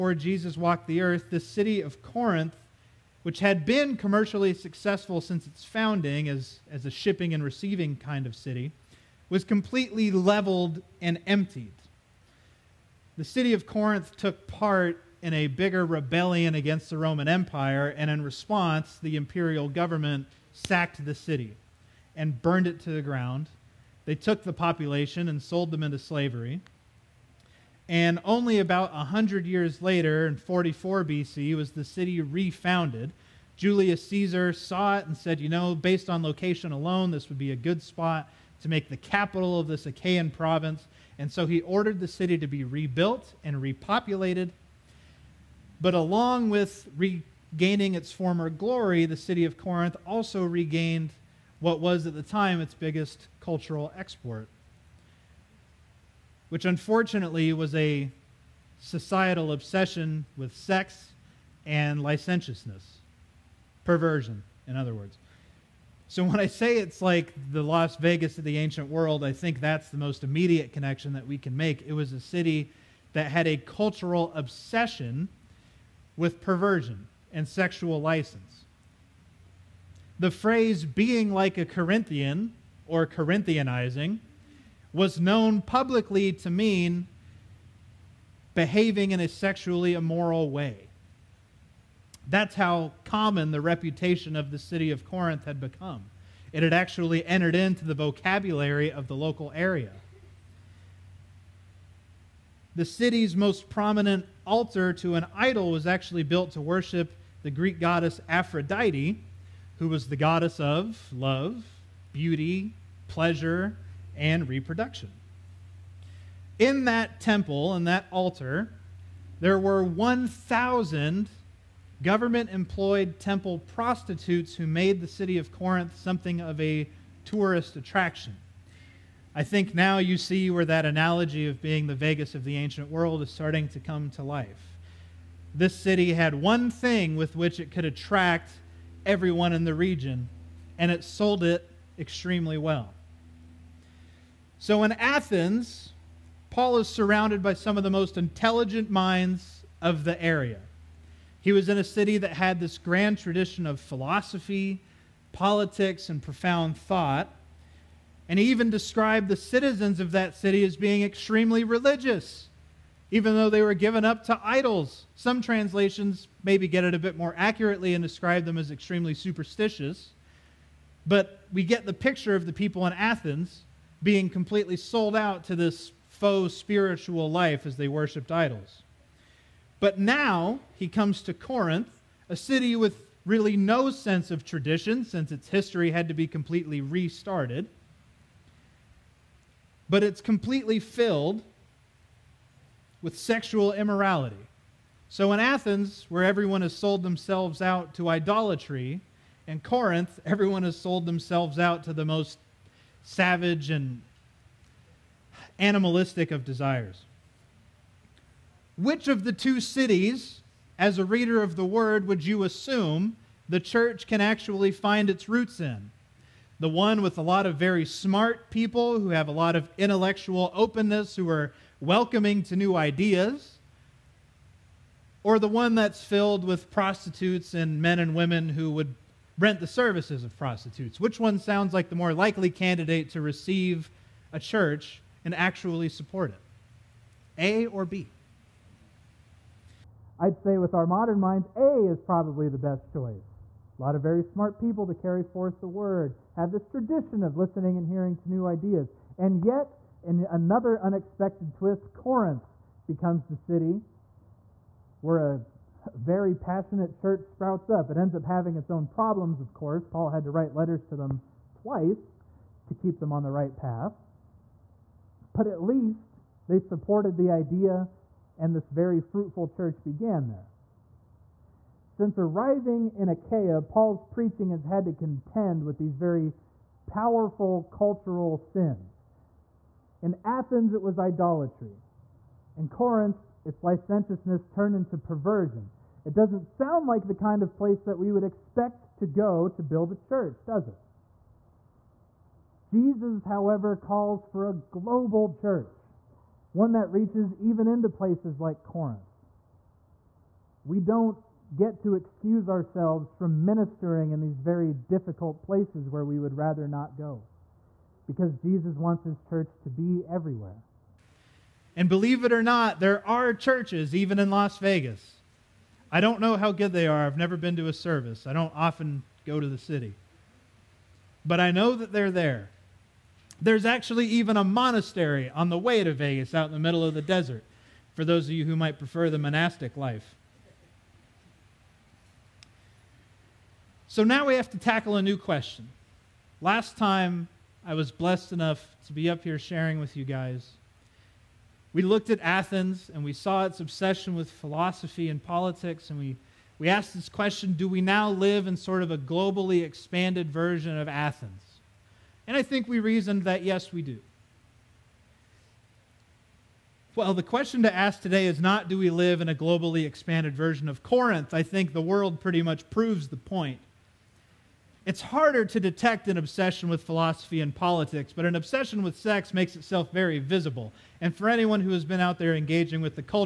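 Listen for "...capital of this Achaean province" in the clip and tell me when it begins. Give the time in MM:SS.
00:38.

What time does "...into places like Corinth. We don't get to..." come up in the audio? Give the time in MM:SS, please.
04:57.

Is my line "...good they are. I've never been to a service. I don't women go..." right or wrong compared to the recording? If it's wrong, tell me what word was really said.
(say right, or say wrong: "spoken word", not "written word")
wrong: "often", not "women".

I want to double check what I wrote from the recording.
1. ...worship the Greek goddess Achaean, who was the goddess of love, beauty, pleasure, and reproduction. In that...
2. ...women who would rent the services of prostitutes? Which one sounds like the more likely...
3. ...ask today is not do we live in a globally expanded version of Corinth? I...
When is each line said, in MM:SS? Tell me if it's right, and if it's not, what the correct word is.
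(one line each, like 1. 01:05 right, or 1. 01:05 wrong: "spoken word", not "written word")
1. 01:46 wrong: "Aphrodite", not "Achaean"
2. 03:48 right
3. 05:57 right.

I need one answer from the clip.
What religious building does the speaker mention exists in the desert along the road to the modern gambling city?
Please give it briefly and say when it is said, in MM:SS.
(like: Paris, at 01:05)
A monastery, at 05:24.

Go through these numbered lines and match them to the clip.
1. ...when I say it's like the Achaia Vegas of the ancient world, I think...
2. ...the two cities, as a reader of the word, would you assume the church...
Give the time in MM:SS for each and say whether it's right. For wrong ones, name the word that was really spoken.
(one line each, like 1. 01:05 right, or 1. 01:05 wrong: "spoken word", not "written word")
1. 01:06 wrong: "Las", not "Achaia"
2. 03:29 right.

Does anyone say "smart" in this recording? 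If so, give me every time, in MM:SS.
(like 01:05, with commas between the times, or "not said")
03:37, 04:04.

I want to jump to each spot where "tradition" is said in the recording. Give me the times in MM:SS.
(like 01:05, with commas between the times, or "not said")
02:33, 03:04, 04:06.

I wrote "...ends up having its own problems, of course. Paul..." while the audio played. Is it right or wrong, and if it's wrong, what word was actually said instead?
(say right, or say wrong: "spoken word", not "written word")
right.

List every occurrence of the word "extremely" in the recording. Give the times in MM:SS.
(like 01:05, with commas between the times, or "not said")
02:21, 02:41, 02:48.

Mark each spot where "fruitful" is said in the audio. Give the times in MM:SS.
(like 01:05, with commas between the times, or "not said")
04:28.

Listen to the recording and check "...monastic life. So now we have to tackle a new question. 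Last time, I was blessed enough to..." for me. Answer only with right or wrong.
right.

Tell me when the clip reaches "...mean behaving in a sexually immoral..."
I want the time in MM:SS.
01:26.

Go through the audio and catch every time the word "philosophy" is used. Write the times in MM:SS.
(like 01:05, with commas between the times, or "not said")
02:33, 05:44, 06:06.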